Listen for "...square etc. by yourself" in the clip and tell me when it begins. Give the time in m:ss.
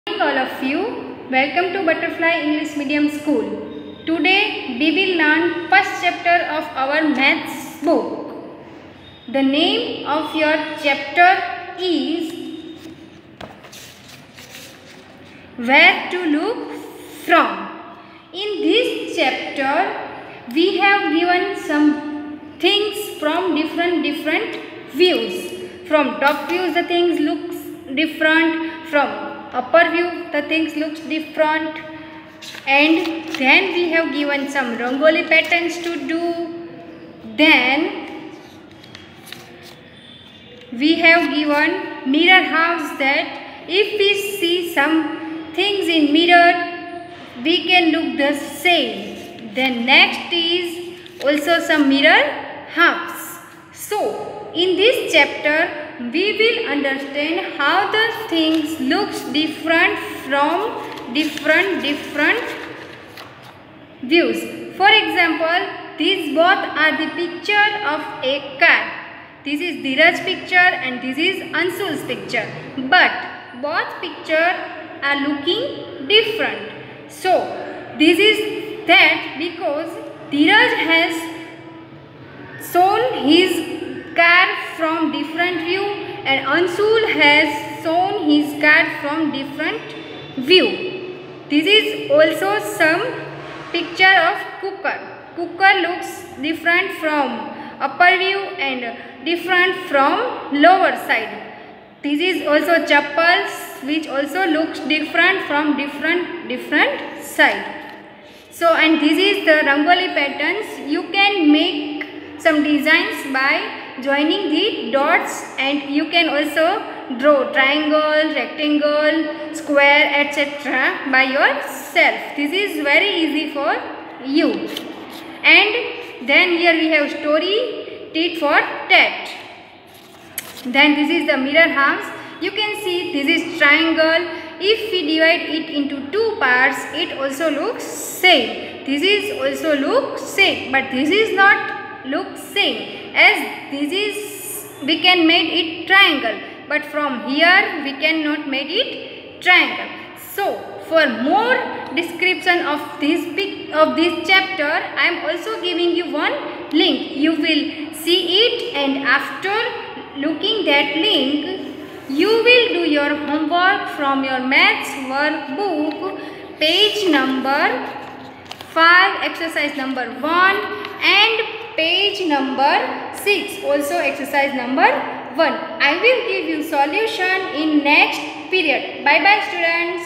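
1:59.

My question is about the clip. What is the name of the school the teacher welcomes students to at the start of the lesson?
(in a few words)
Butterfly English Medium School.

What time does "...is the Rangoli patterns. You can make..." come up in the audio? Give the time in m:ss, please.
1:49.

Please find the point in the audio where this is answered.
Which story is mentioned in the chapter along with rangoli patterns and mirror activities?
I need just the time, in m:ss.
2:08.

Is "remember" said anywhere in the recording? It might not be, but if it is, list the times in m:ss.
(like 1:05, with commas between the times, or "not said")
not said.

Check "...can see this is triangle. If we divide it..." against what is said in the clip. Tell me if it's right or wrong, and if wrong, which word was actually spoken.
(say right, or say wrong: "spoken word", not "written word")
right.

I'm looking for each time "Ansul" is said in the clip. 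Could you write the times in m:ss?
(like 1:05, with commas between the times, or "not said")
1:11, 1:26.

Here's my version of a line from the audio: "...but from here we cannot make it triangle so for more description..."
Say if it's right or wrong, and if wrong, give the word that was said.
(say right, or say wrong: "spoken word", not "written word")
right.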